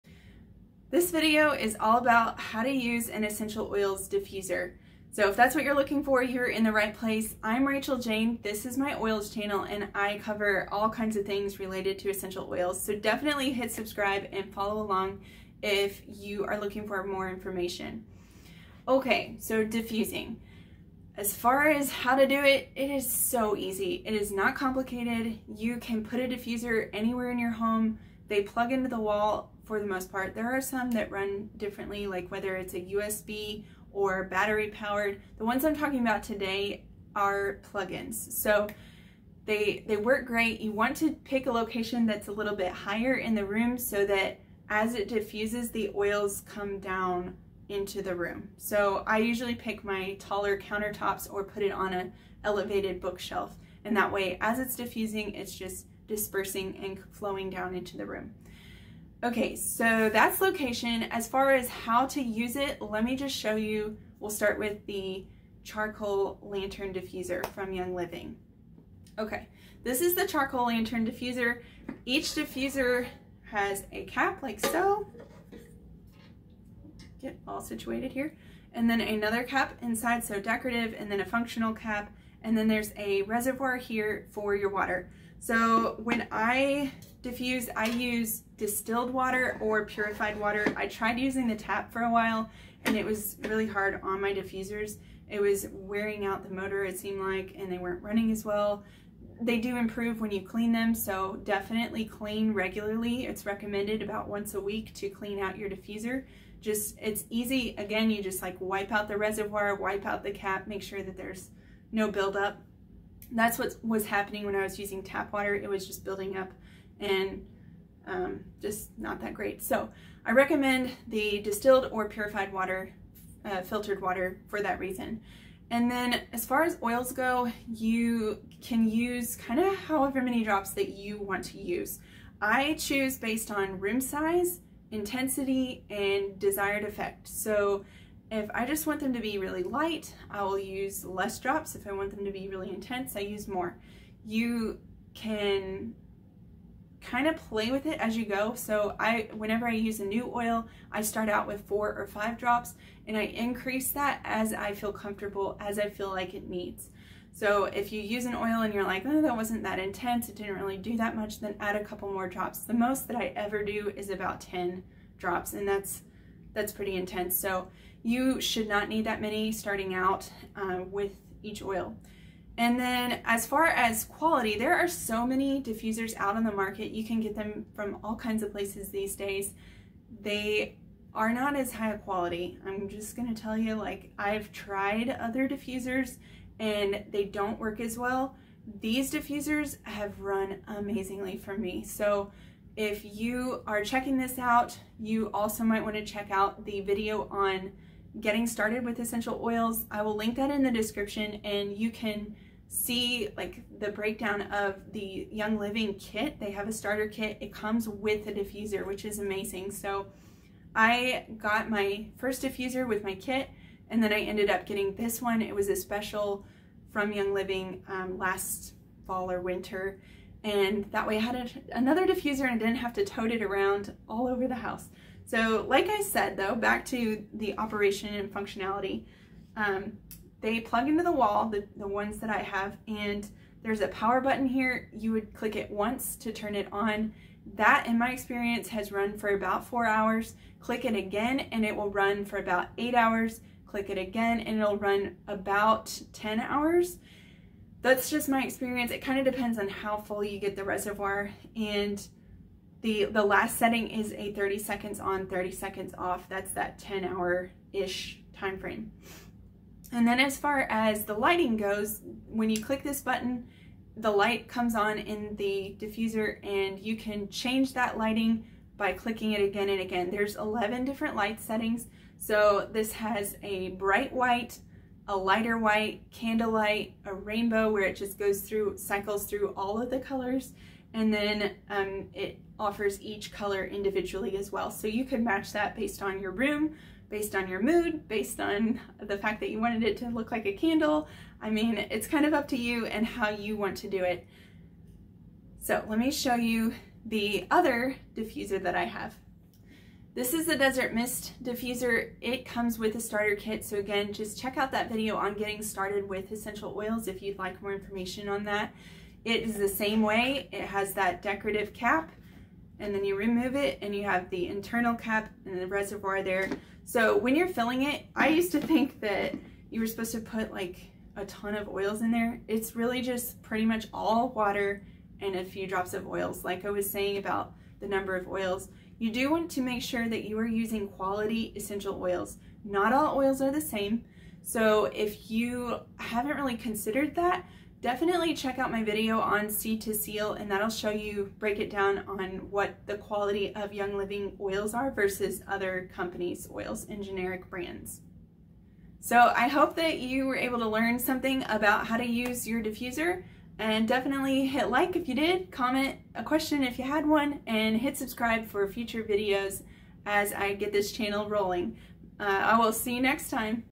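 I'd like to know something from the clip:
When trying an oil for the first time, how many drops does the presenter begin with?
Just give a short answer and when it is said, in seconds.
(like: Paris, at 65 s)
4 or 5 drops, at 151 s.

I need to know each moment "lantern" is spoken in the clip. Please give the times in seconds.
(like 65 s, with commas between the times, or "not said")
66 s, 70 s.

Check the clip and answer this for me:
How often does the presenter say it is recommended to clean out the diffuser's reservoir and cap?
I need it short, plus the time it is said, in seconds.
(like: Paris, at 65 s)
once a week, at 104 s.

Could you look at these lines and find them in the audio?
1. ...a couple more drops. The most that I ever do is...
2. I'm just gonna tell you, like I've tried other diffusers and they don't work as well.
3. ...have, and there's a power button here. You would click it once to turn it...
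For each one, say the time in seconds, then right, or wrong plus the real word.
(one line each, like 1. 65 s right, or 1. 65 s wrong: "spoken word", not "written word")
1. 161 s right
2. 182 s right
3. 232 s right.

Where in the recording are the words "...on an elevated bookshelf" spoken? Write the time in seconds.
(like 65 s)
51 s.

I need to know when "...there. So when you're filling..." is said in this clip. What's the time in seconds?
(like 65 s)
316 s.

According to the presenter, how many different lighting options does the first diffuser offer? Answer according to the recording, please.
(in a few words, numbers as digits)
11.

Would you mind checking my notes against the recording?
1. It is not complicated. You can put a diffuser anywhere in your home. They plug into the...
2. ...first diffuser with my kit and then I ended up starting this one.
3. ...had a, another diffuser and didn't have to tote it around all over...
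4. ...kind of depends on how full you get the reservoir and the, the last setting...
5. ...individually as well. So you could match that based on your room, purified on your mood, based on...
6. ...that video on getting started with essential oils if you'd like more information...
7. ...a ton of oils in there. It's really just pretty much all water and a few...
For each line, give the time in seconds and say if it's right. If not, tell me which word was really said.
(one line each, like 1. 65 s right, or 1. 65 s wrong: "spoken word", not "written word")
1. 24 s right
2. 212 s wrong: "getting", not "starting"
3. 221 s right
4. 249 s right
5. 283 s wrong: "based", not "purified"
6. 304 s right
7. 321 s right.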